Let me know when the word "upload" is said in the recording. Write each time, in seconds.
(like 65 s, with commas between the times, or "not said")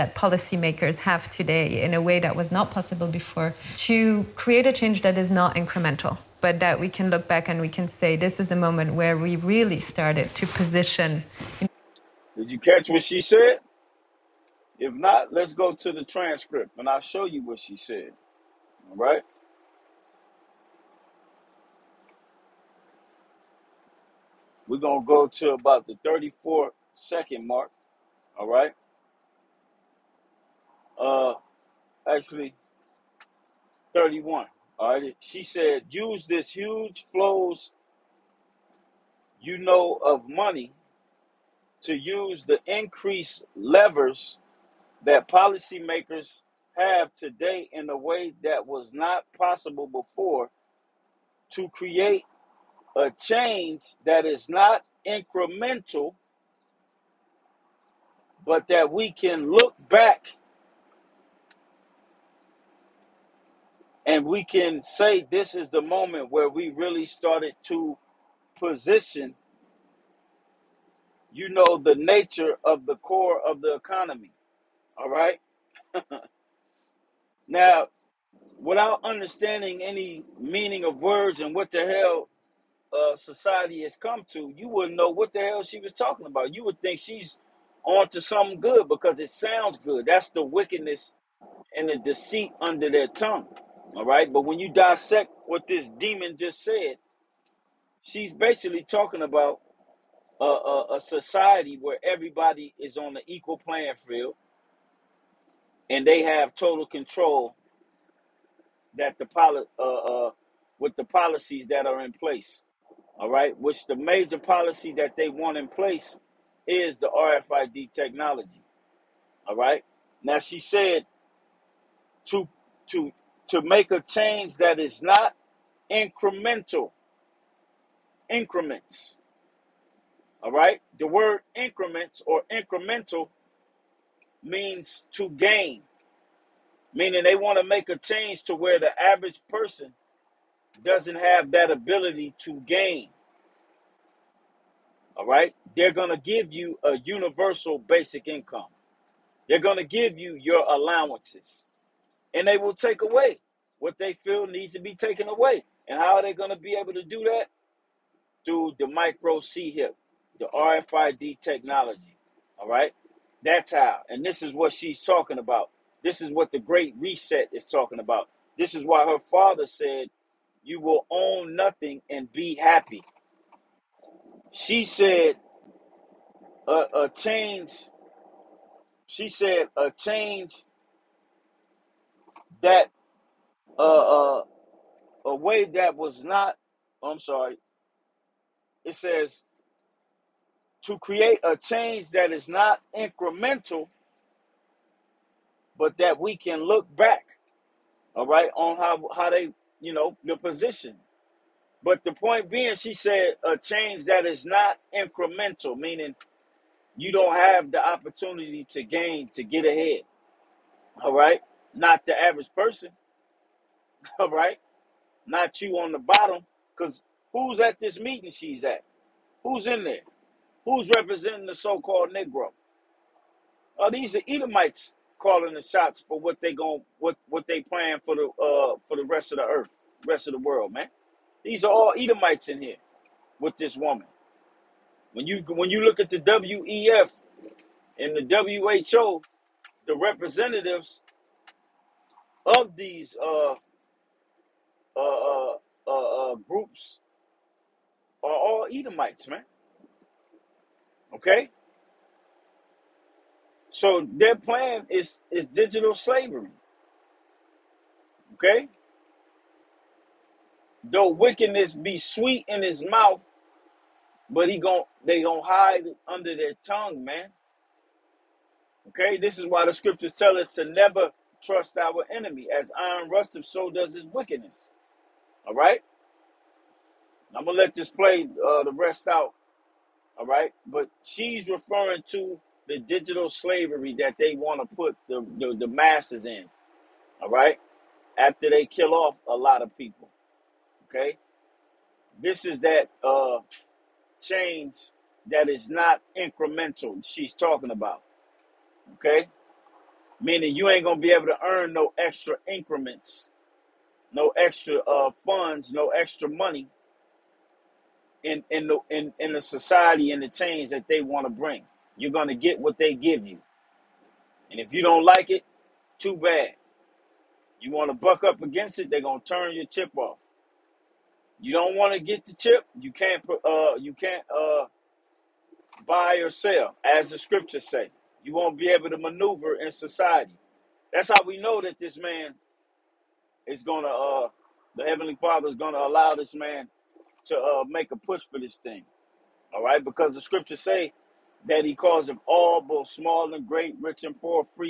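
not said.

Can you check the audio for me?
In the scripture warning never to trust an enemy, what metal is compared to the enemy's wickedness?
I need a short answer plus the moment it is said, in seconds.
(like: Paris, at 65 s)
iron, at 272 s.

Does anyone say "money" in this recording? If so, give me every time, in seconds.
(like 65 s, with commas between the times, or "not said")
40 s, 306 s.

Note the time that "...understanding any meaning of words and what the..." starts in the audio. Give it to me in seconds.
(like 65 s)
79 s.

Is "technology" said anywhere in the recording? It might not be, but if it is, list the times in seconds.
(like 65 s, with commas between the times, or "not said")
117 s, 161 s.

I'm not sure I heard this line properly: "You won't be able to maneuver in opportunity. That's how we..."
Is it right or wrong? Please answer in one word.
wrong.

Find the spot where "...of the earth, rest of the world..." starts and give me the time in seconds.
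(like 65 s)
229 s.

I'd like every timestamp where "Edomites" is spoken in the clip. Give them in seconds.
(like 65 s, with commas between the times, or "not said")
224 s, 231 s, 248 s.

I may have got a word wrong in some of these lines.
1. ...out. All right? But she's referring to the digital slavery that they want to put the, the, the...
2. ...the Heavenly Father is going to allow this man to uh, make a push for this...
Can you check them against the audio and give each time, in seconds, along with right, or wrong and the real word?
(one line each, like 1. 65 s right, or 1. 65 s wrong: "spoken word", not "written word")
1. 279 s right
2. 334 s right.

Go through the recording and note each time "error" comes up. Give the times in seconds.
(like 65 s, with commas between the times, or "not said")
not said.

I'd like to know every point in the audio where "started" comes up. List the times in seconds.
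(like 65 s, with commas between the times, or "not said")
9 s, 67 s.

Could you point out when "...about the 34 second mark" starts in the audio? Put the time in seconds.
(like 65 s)
25 s.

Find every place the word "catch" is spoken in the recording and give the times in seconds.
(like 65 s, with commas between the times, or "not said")
12 s.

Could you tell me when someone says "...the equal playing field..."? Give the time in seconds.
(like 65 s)
103 s.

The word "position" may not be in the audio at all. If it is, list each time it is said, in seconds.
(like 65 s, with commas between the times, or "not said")
10 s, 68 s, 200 s.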